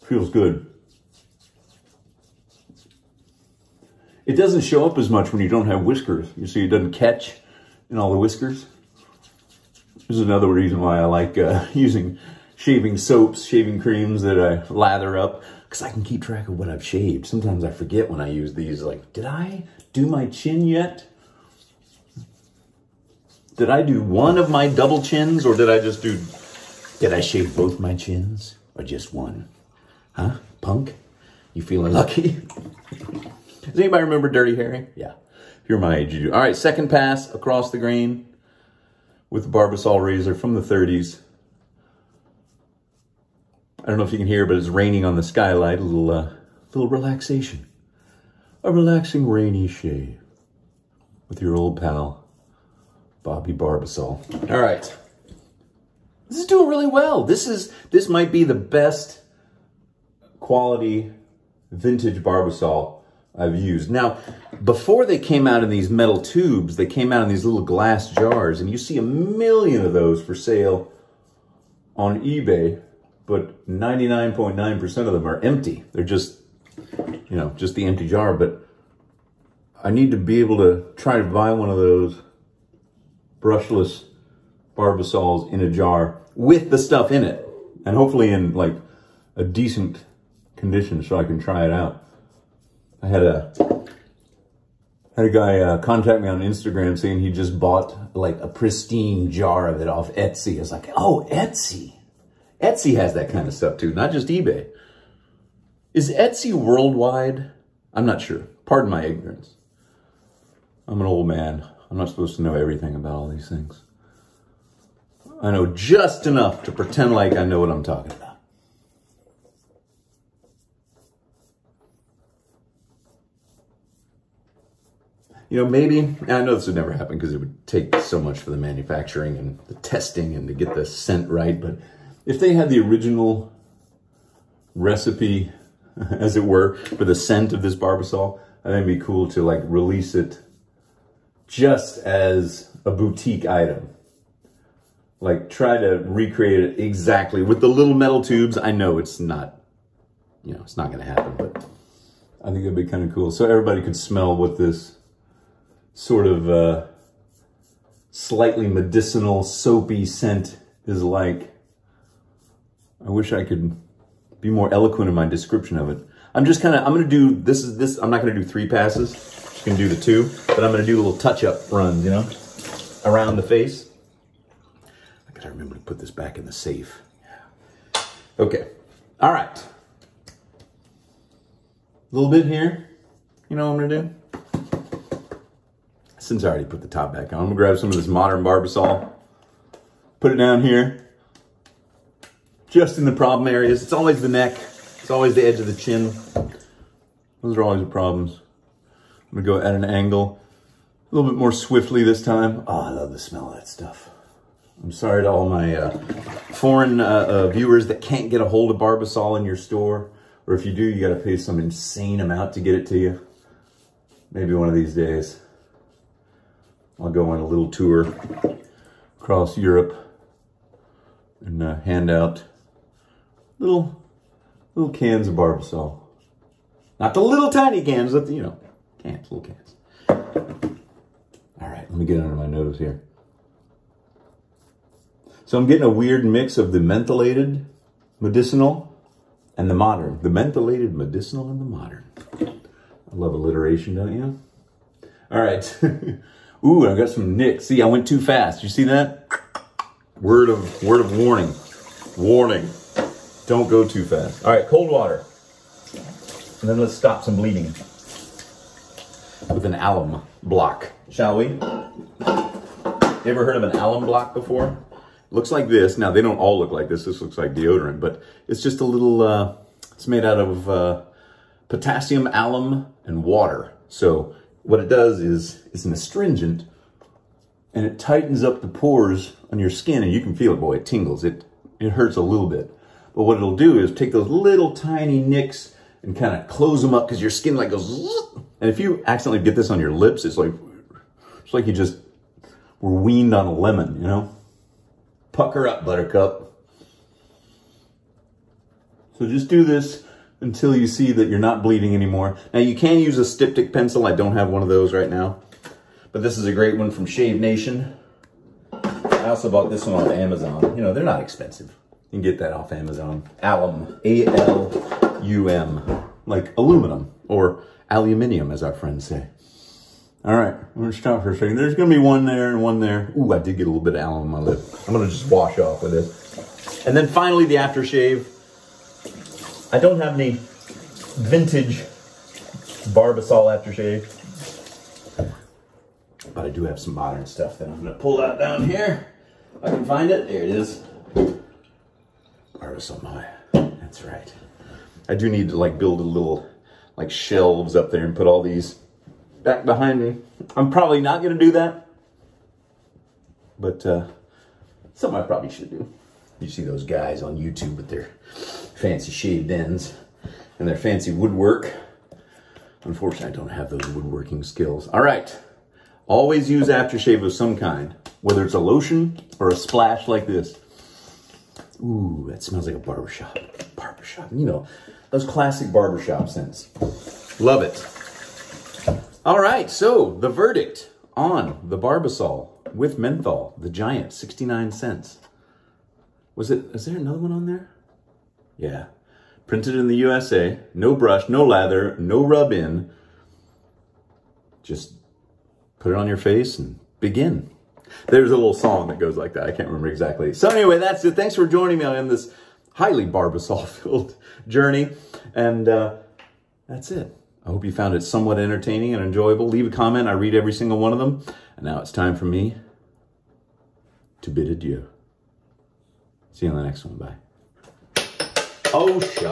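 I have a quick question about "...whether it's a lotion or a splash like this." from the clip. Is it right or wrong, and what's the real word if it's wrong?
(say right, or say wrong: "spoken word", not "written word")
right.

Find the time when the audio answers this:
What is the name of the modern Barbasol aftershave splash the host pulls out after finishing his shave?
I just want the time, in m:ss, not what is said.
5:42.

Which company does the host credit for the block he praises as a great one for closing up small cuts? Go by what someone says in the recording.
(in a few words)
Shave Nation.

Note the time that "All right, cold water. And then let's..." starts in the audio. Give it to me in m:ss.
4:14.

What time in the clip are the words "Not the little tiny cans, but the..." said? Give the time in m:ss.
3:46.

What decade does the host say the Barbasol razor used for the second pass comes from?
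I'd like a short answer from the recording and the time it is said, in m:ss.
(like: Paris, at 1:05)
1930s, at 0:40.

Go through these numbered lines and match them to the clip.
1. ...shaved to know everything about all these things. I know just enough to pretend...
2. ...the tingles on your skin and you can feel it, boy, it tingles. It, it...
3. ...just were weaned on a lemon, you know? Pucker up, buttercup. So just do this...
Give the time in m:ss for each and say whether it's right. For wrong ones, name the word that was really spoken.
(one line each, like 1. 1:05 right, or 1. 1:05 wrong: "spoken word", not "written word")
1. 1:52 wrong: "supposed", not "shaved"
2. 4:38 wrong: "pores", not "tingles"
3. 4:51 right.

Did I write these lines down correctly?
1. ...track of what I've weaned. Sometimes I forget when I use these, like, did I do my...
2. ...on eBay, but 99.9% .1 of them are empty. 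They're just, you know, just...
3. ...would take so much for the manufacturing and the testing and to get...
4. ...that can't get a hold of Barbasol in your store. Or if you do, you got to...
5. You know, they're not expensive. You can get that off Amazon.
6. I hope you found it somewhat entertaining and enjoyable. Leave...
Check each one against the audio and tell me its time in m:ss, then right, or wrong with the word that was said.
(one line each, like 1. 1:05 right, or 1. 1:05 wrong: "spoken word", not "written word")
1. 0:16 wrong: "shaved", not "weaned"
2. 1:11 wrong: "9", not "1"
3. 2:07 right
4. 3:27 right
5. 5:10 right
6. 6:47 right.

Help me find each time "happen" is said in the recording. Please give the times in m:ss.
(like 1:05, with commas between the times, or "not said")
2:06, 2:31.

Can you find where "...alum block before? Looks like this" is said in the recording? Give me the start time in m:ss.
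4:23.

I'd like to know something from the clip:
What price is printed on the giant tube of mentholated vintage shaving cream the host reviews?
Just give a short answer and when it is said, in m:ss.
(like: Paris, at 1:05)
69 cents, at 6:24.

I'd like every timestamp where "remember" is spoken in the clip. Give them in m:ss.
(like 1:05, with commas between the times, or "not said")
0:34, 2:55, 6:39.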